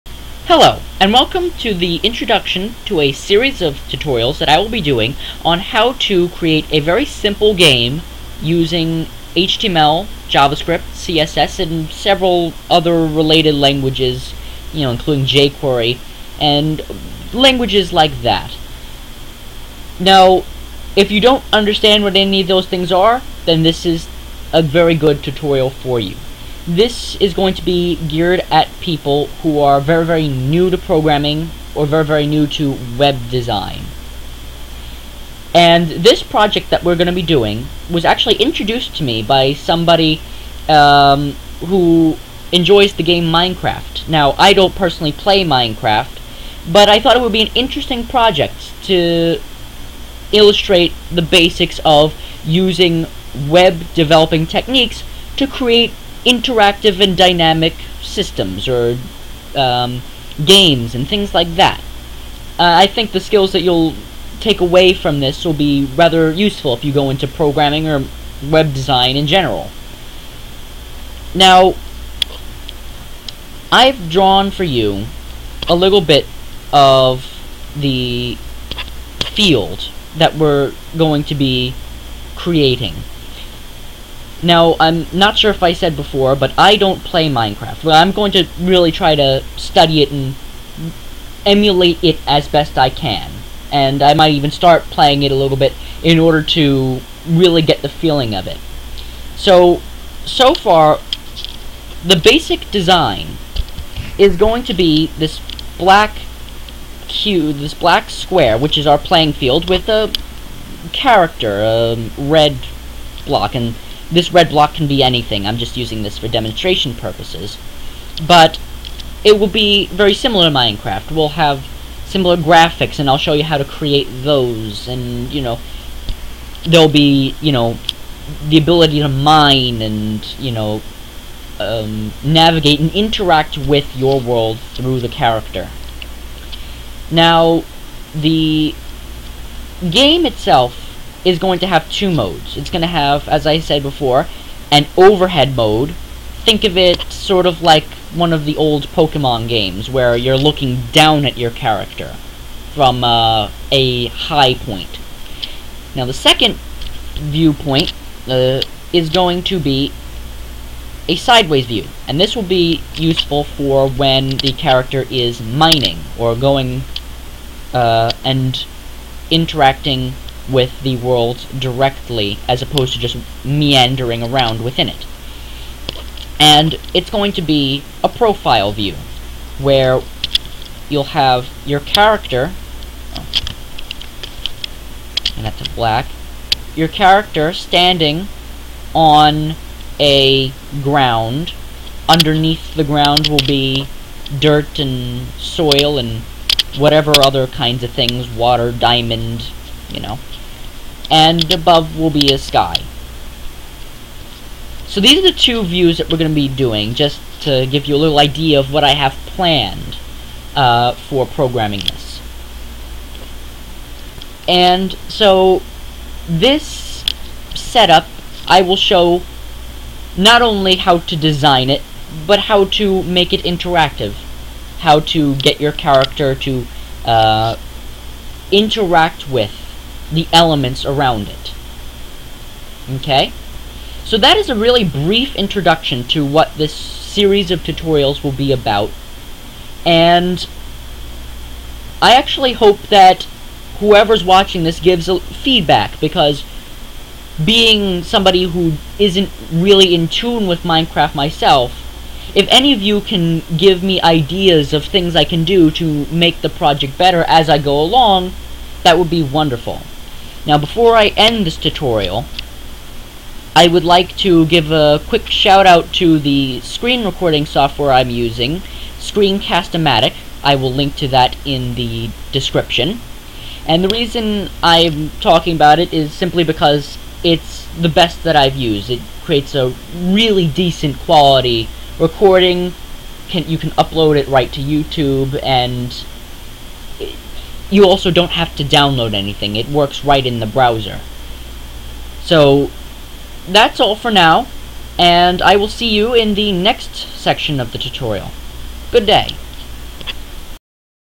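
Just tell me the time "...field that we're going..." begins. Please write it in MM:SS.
01:19.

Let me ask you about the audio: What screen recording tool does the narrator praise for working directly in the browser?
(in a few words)
Screencast-O-Matic.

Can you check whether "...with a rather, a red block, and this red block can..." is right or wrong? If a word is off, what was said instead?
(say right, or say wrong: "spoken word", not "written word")
wrong: "character", not "rather".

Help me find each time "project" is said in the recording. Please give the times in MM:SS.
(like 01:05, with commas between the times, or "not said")
00:36, 00:48, 04:16.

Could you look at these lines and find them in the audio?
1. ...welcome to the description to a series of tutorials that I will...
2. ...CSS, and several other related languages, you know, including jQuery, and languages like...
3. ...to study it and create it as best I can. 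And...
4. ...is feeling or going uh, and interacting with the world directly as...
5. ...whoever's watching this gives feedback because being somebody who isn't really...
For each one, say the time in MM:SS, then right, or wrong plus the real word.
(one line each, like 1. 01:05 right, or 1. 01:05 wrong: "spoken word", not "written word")
1. 00:01 wrong: "introduction", not "description"
2. 00:10 right
3. 01:29 wrong: "emulate", not "create"
4. 02:45 wrong: "mining", not "feeling"
5. 04:03 right.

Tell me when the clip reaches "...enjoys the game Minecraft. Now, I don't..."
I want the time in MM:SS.
00:42.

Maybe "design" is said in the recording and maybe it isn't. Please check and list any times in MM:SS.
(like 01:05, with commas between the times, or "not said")
00:33, 01:08, 01:42, 03:41.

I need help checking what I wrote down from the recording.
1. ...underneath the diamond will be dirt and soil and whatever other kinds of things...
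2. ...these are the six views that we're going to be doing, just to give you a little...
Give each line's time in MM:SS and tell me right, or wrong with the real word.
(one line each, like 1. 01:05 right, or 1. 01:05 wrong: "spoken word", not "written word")
1. 03:12 wrong: "ground", not "diamond"
2. 03:25 wrong: "two", not "six".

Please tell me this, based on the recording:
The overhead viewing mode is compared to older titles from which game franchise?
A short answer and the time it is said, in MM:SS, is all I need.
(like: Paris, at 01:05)
Pokemon, at 02:28.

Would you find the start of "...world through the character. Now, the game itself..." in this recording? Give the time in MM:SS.
02:14.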